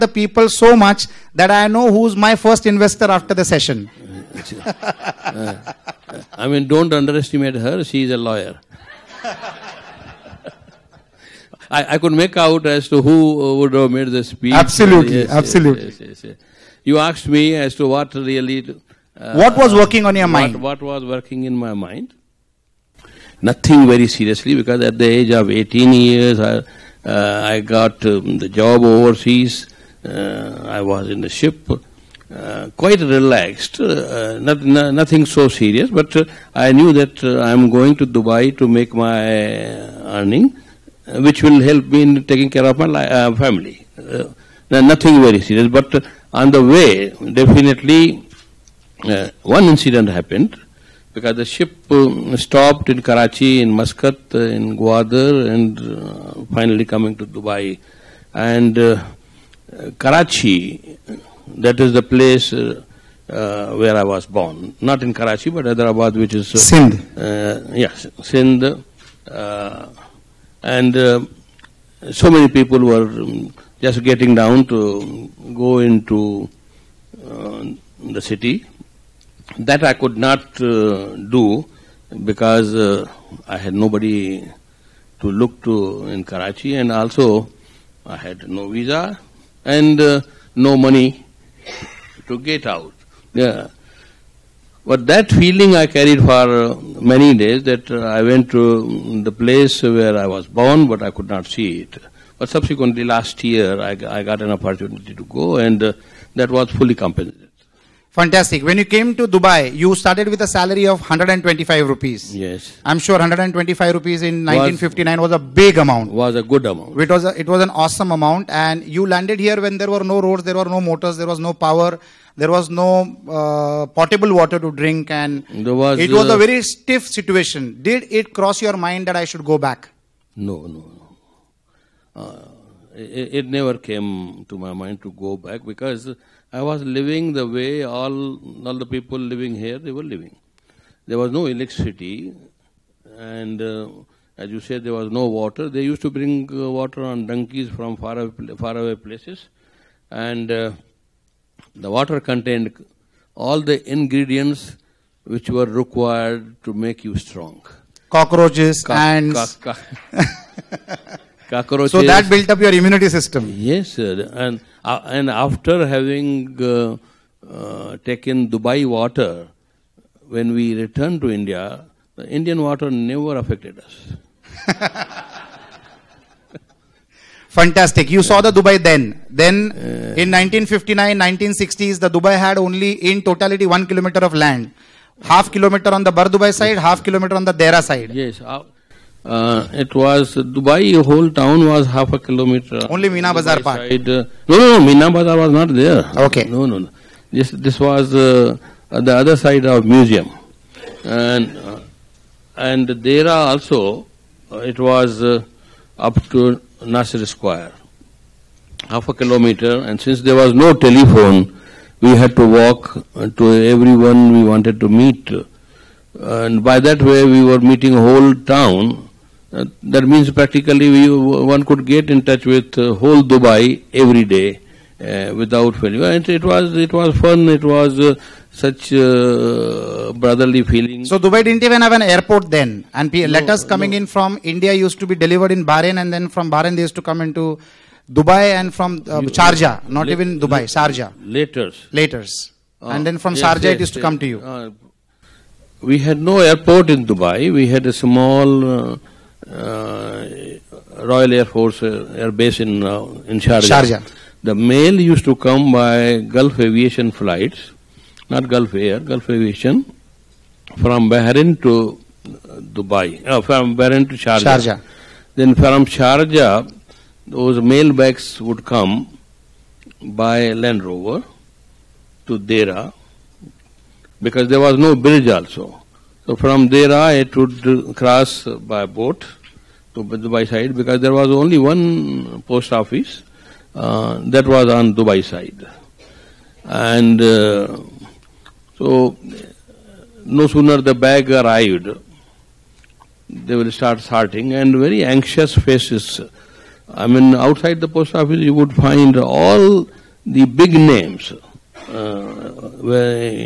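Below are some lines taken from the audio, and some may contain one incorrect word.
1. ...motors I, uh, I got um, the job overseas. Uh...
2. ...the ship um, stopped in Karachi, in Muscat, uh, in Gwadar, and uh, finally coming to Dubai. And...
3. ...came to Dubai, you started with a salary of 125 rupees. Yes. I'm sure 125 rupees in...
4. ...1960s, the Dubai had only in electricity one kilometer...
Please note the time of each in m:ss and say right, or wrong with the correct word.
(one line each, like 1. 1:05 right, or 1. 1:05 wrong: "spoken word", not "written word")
1. 0:25 wrong: "years", not "motors"
2. 0:51 right
3. 1:48 right
4. 3:01 wrong: "totality", not "electricity".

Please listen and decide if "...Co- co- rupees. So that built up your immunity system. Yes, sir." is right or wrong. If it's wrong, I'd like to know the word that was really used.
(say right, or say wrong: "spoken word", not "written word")
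wrong: "cockroaches", not "rupees".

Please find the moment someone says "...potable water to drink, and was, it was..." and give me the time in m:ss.
2:03.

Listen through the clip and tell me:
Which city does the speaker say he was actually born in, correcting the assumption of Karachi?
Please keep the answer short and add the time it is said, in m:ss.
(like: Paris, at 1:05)
Hyderabad, at 1:05.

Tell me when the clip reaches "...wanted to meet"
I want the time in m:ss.
3:34.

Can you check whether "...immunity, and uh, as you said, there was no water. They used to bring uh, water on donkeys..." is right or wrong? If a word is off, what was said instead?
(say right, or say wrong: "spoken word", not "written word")
wrong: "electricity", not "immunity".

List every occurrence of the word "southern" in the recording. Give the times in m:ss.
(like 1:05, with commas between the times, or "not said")
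not said.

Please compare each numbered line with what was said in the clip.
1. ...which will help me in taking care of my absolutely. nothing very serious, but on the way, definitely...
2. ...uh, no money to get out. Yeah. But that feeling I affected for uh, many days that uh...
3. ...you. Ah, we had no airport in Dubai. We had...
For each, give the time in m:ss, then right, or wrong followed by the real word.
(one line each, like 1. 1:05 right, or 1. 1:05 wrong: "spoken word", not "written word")
1. 0:41 wrong: "family", not "absolutely"
2. 1:29 wrong: "carried", not "affected"
3. 4:04 right.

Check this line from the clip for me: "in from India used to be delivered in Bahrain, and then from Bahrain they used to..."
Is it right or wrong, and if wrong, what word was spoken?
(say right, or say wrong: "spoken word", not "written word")
right.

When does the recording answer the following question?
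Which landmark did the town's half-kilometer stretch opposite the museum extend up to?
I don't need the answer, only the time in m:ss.
3:26.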